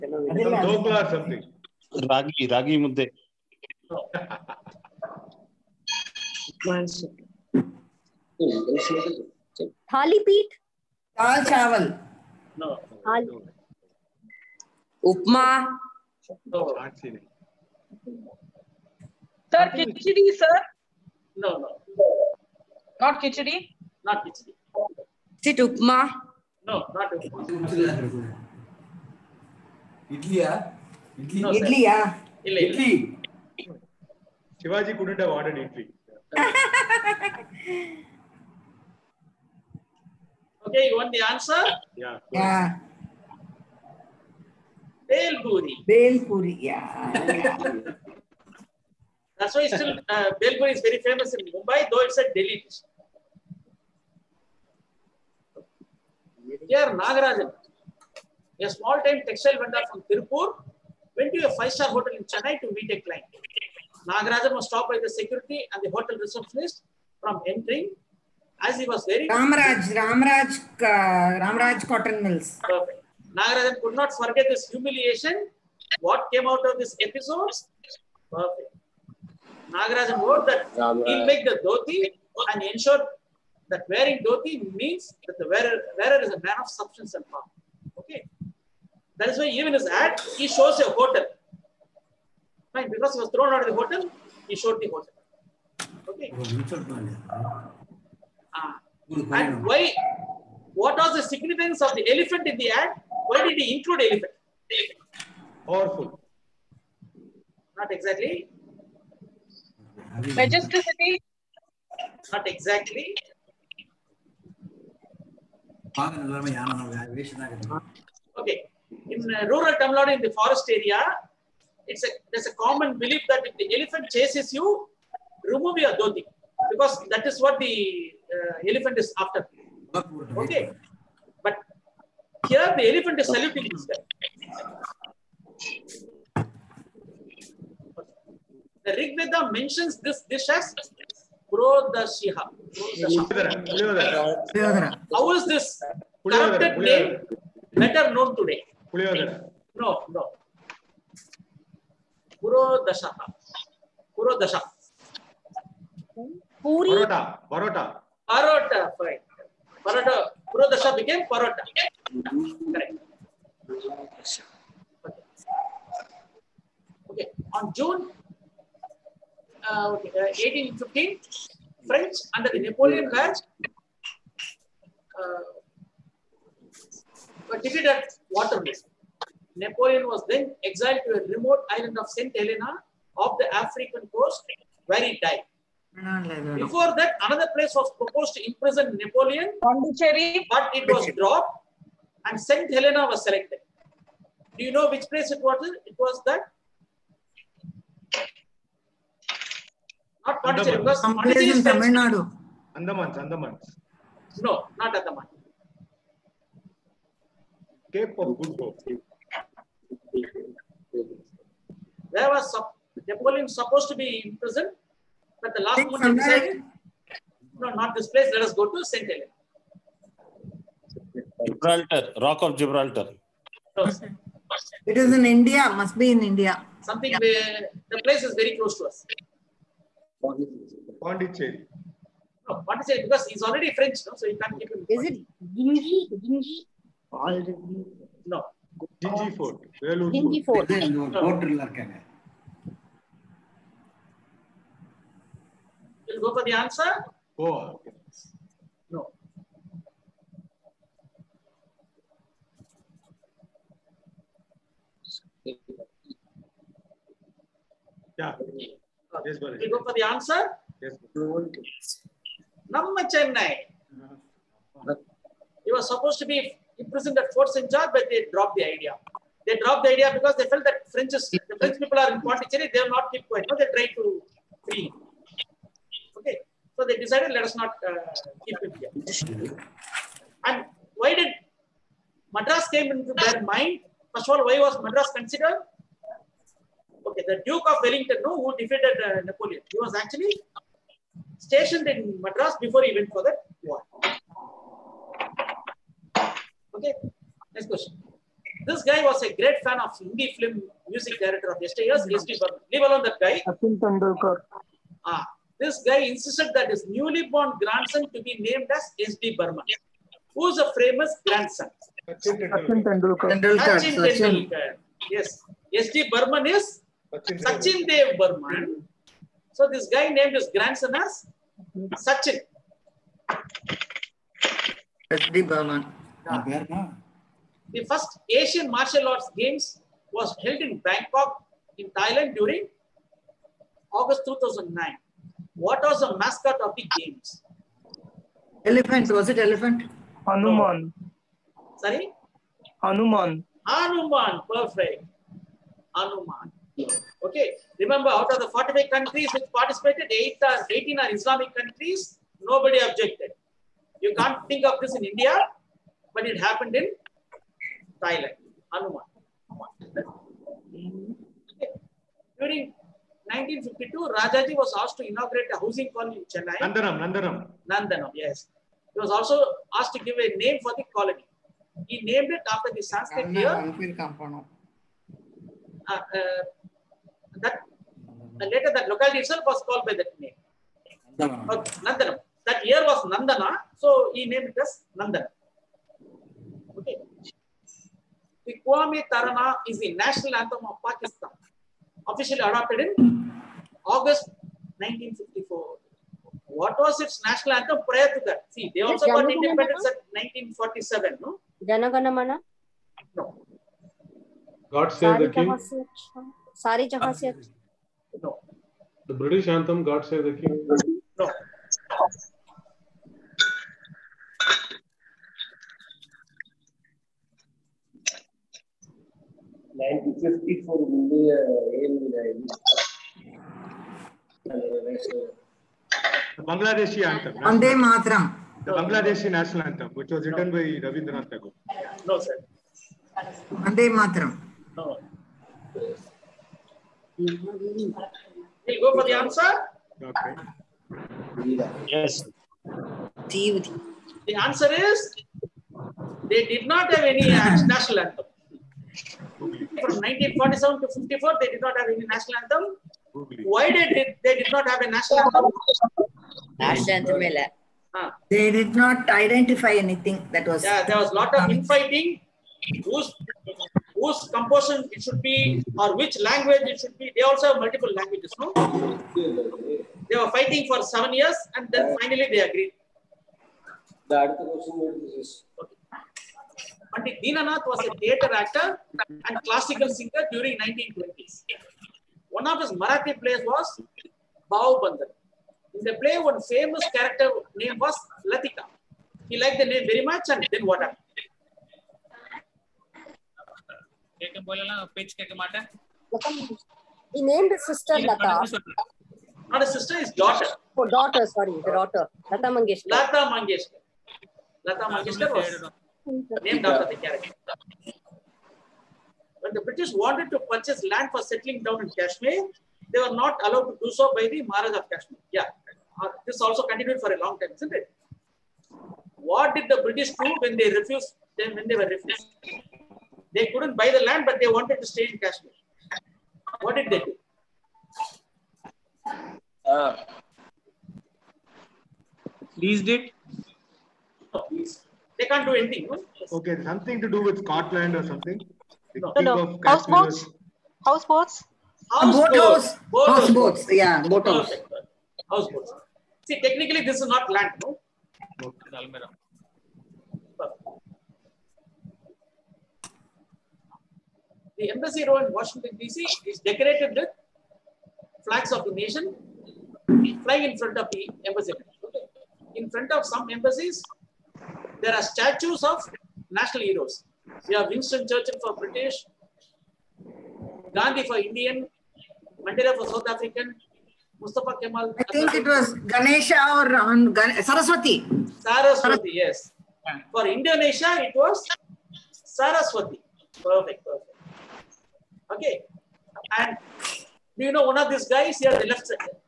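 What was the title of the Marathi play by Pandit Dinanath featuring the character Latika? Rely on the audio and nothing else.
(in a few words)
Bau Bandar.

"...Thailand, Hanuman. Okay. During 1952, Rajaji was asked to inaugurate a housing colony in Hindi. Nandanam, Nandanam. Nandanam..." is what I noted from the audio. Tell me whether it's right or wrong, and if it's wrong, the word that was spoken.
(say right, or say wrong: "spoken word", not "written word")
wrong: "Chennai", not "Hindi".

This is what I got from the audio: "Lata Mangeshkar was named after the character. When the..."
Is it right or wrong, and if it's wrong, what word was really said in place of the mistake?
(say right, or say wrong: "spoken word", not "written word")
right.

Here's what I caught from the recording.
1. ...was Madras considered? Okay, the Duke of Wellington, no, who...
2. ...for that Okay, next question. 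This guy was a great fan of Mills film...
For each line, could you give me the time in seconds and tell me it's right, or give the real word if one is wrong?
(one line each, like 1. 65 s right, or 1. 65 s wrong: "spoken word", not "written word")
1. 284 s right
2. 293 s wrong: "Hindi", not "Mills".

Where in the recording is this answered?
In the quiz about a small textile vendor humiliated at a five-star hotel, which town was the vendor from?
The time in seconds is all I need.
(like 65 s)
60 s.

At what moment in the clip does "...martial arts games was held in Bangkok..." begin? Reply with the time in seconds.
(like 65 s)
328 s.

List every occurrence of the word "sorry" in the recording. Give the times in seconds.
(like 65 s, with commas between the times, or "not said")
341 s, 501 s.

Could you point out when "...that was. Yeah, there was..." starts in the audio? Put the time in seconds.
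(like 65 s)
460 s.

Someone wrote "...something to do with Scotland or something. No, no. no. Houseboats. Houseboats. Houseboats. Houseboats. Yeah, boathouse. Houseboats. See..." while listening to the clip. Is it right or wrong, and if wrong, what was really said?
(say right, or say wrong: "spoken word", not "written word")
right.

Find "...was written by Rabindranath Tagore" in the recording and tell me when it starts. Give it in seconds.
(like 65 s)
430 s.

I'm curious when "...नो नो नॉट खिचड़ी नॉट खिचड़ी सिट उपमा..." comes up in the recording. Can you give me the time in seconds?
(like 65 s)
21 s.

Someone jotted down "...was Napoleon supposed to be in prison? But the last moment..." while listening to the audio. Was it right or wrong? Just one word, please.
right.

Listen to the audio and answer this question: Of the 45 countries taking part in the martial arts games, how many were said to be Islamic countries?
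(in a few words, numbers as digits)
18.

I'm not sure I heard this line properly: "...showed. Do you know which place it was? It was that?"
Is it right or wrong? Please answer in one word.
wrong.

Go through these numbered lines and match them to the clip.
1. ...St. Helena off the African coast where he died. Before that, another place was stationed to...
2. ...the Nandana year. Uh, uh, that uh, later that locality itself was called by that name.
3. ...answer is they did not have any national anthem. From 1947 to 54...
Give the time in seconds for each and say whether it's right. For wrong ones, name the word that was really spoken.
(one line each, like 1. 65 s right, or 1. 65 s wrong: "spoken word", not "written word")
1. 182 s wrong: "proposed", not "stationed"
2. 372 s wrong: "Sanskrit", not "Nandana"
3. 444 s right.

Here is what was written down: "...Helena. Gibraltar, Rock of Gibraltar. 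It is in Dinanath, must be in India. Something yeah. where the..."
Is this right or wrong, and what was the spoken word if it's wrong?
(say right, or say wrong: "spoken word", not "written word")
wrong: "India", not "Dinanath".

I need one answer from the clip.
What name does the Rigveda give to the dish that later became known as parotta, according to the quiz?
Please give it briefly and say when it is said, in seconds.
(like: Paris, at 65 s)
Prodashiha, at 141 s.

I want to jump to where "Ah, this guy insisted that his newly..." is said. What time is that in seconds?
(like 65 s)
305 s.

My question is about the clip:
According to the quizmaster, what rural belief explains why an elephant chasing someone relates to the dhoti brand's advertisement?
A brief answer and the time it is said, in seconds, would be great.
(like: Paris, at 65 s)
Remove your dhoti, at 125 s.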